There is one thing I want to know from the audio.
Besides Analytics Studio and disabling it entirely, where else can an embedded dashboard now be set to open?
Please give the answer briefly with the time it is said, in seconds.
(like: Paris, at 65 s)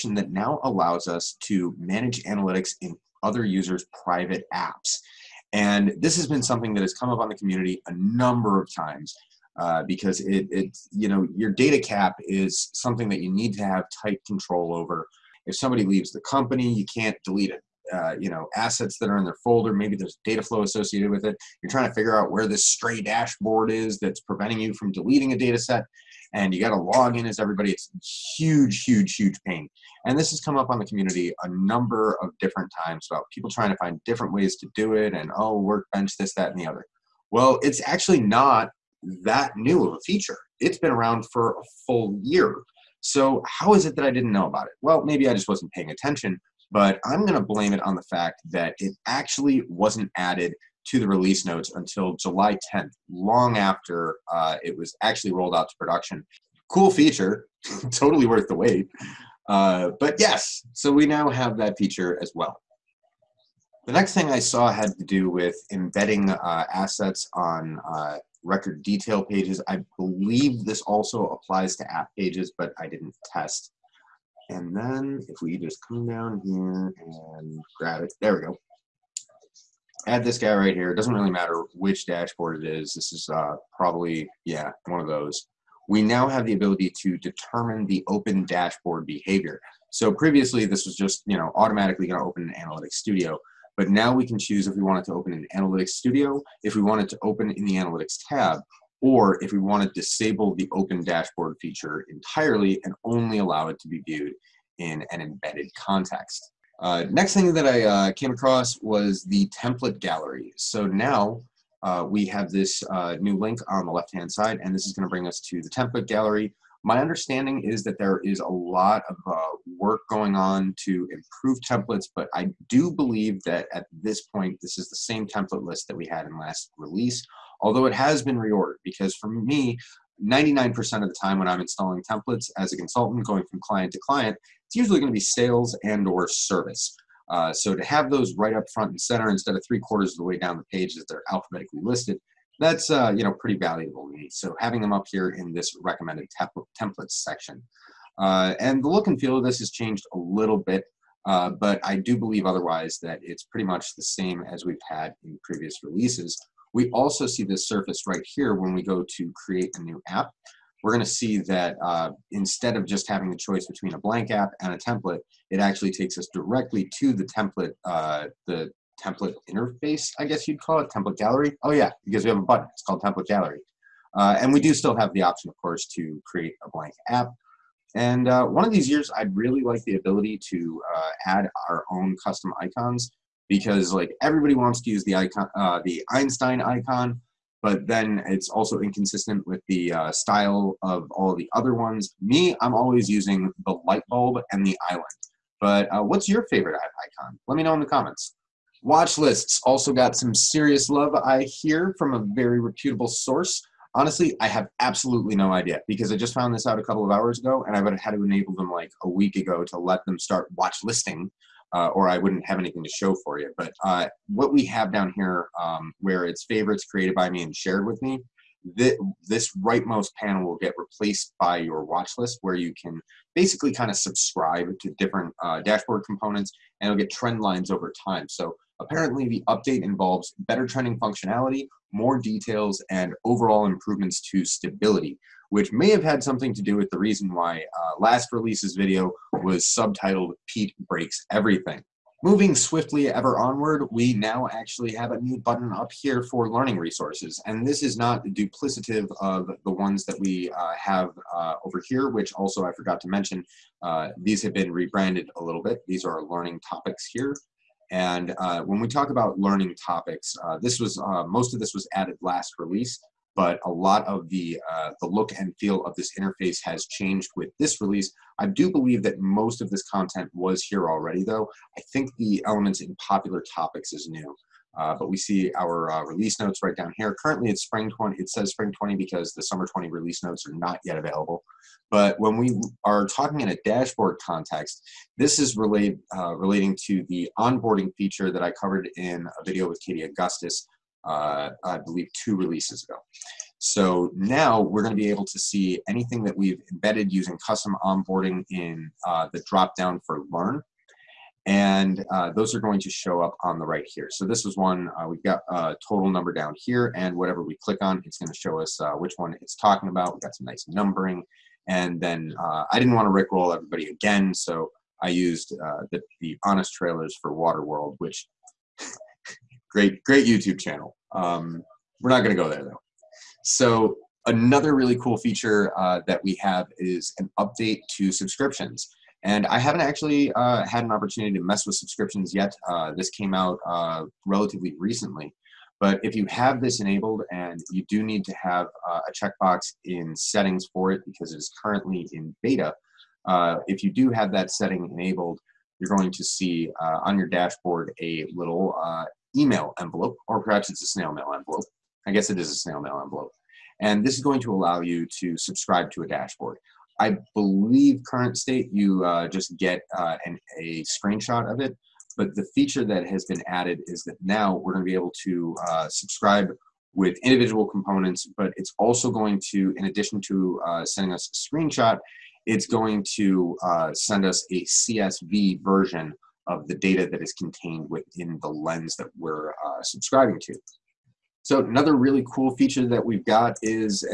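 Analytics tab, at 97 s.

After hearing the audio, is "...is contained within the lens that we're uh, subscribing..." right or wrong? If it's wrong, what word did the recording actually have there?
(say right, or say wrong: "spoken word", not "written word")
right.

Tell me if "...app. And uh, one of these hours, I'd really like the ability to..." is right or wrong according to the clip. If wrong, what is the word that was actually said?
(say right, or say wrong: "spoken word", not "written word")
wrong: "years", not "hours".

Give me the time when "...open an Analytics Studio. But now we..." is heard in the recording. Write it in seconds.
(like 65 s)
92 s.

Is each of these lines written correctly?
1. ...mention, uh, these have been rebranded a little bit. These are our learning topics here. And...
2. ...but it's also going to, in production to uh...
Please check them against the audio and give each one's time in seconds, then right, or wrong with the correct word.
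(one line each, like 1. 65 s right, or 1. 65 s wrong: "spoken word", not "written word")
1. 253 s right
2. 368 s wrong: "addition", not "production".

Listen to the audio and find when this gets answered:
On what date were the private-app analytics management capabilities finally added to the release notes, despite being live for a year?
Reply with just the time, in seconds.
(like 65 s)
52 s.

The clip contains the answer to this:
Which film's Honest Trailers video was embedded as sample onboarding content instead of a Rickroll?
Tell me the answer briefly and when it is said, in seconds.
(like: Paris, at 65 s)
Waterworld, at 317 s.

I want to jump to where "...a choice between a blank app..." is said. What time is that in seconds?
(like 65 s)
163 s.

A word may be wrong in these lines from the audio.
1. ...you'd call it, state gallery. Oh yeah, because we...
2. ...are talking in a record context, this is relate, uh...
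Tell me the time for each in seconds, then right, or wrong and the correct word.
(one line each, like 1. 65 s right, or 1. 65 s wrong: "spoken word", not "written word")
1. 170 s wrong: "template", not "state"
2. 282 s wrong: "dashboard", not "record".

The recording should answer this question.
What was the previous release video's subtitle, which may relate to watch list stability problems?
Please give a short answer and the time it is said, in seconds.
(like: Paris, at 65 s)
Pete Breaks Everything, at 240 s.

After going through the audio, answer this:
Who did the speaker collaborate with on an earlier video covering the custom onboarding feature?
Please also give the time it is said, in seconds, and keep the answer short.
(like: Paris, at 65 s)
Katie Augustus, at 289 s.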